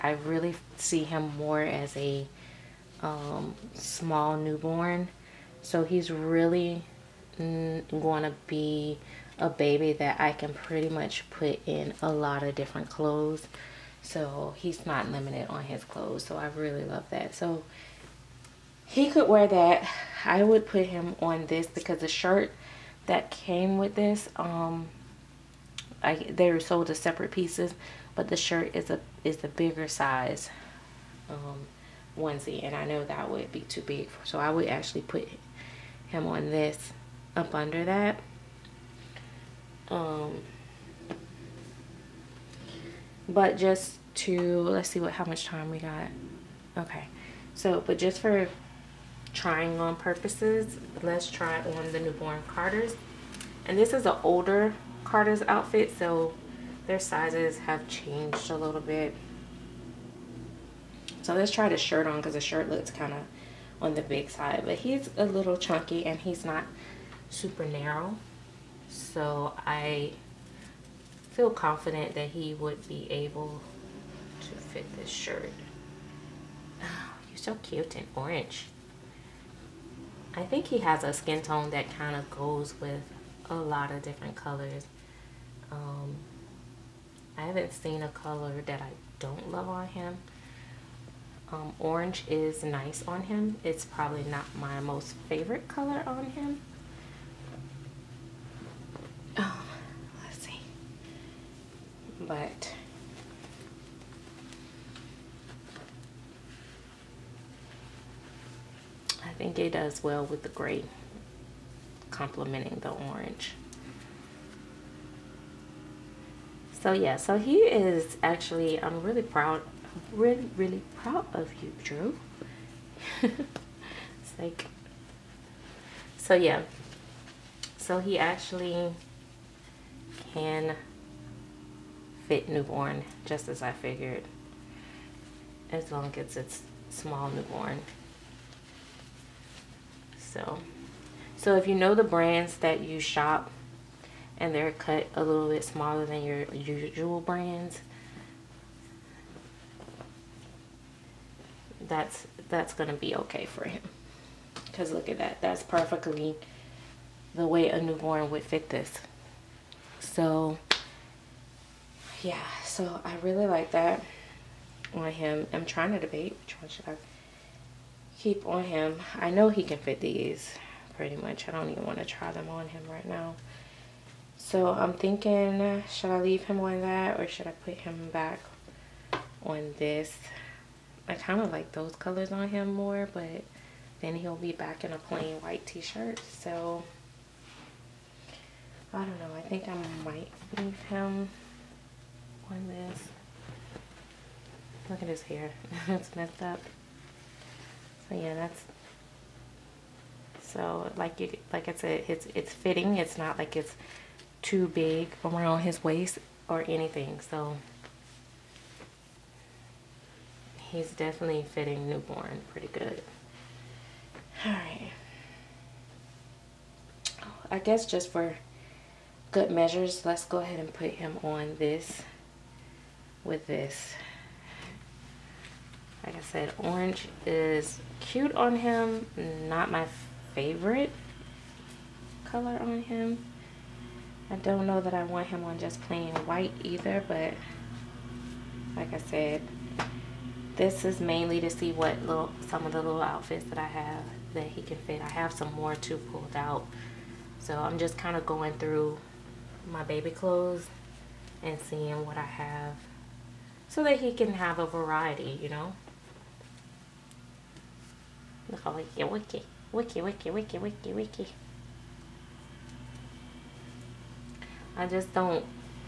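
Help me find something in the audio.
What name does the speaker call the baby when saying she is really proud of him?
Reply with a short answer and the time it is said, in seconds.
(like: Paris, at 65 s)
Drew, at 121 s.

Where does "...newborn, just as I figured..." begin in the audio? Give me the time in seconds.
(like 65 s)
132 s.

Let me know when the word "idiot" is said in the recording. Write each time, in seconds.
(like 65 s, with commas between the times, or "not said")
not said.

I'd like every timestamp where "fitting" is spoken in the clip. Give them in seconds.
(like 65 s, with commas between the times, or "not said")
202 s, 211 s.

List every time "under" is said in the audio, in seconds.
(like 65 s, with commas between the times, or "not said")
37 s.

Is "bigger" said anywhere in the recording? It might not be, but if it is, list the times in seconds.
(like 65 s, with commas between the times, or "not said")
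29 s.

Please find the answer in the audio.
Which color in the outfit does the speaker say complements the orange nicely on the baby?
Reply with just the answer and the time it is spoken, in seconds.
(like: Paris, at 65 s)
gray, at 110 s.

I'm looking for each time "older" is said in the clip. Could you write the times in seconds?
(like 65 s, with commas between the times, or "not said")
54 s.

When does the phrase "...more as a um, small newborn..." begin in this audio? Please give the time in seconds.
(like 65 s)
1 s.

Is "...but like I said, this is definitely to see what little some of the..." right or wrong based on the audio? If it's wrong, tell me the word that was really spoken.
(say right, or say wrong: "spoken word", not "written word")
wrong: "mainly", not "definitely".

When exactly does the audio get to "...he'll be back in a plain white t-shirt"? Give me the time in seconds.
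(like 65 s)
184 s.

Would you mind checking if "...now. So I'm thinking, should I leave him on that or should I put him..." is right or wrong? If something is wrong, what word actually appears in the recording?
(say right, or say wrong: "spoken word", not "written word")
right.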